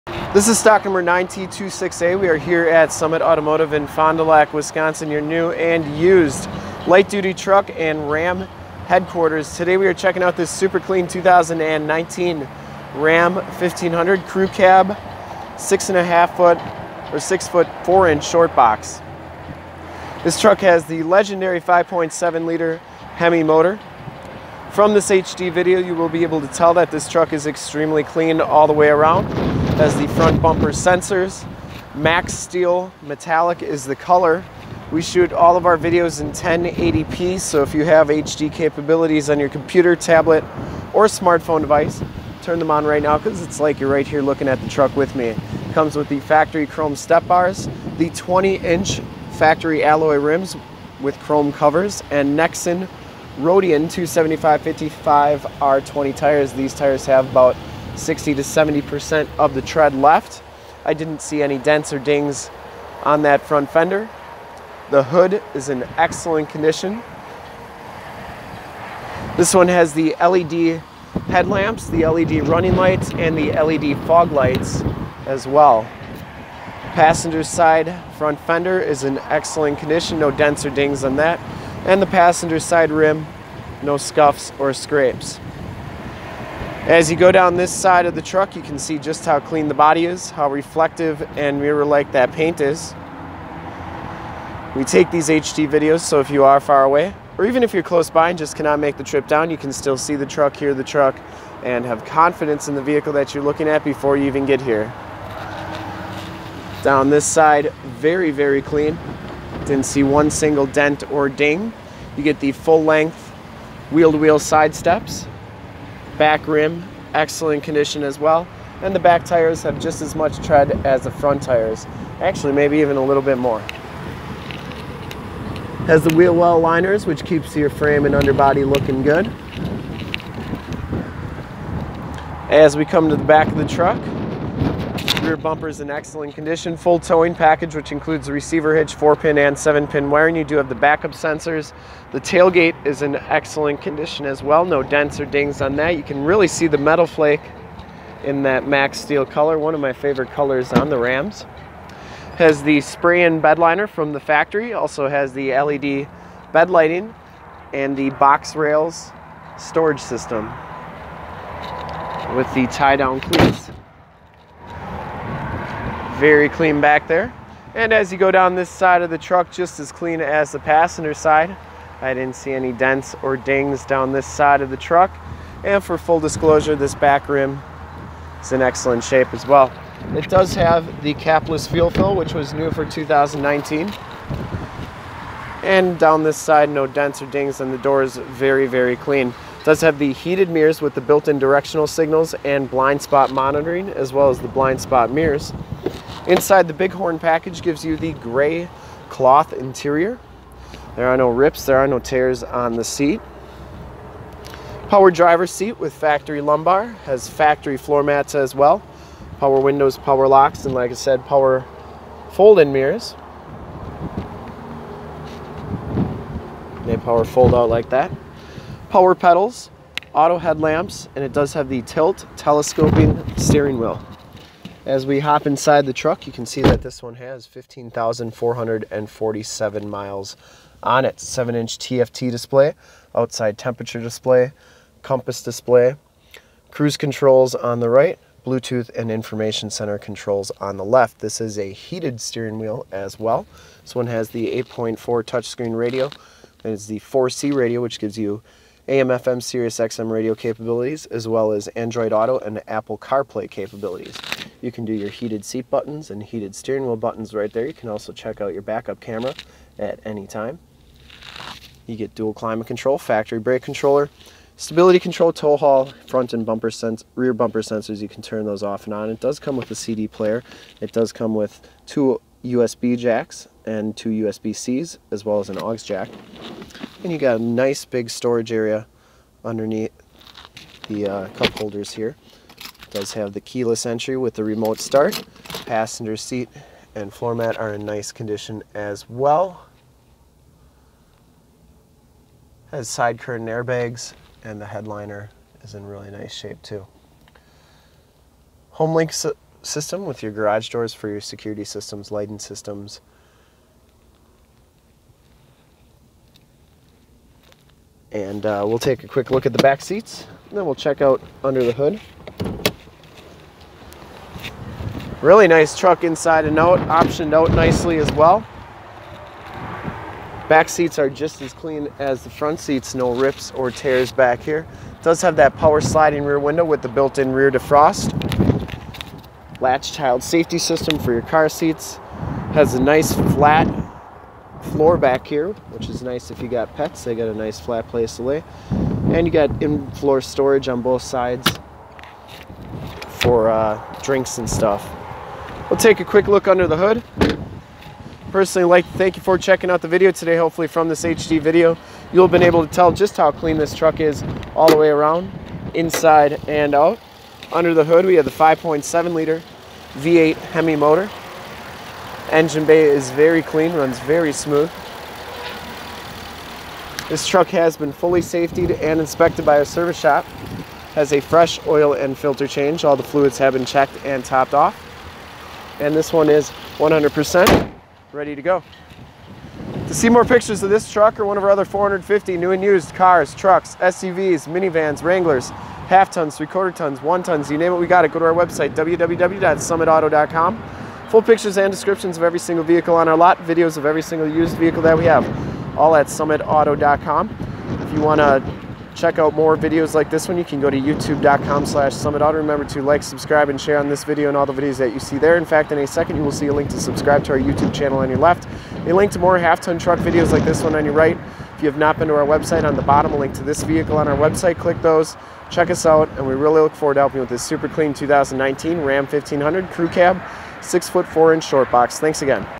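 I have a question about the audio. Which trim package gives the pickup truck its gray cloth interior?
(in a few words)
Bighorn.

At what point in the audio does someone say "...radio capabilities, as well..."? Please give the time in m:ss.
4:10.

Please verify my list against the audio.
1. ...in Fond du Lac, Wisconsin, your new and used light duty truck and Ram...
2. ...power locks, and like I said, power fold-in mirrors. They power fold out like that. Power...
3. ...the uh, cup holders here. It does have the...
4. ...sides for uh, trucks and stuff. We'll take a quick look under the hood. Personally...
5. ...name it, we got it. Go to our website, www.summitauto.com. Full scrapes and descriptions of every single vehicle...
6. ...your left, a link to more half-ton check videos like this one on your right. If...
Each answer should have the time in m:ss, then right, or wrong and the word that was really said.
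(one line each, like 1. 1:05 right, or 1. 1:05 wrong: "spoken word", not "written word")
1. 0:03 right
2. 3:29 right
3. 4:40 right
4. 5:41 wrong: "drinks", not "trucks"
5. 6:27 wrong: "pictures", not "scrapes"
6. 6:48 wrong: "truck", not "check".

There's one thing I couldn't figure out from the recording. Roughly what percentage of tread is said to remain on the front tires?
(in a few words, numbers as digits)
60 to 70%.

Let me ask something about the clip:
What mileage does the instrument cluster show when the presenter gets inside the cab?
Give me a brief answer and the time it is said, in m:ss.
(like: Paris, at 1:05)
15,447, at 3:47.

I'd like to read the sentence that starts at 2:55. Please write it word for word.
And for full disclosure, this back rim is in excellent shape as well.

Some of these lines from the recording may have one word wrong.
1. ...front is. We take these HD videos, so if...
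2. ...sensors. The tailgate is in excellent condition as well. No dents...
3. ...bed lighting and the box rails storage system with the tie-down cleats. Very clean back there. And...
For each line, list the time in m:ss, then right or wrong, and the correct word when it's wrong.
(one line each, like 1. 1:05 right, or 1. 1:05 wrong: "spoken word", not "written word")
1. 1:32 wrong: "paint", not "front"
2. 2:21 right
3. 2:36 right.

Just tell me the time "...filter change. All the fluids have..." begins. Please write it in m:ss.
6:12.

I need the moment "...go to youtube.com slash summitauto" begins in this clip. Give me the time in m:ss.
6:40.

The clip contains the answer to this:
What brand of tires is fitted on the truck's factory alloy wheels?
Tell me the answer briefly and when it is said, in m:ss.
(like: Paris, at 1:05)
Nexen Roadian, at 0:52.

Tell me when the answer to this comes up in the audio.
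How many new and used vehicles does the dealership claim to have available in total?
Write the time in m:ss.
6:21.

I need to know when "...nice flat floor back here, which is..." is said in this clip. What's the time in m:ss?
5:32.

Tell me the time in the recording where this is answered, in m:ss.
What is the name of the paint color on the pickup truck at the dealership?
0:31.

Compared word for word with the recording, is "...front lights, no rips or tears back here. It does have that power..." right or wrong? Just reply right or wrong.
wrong.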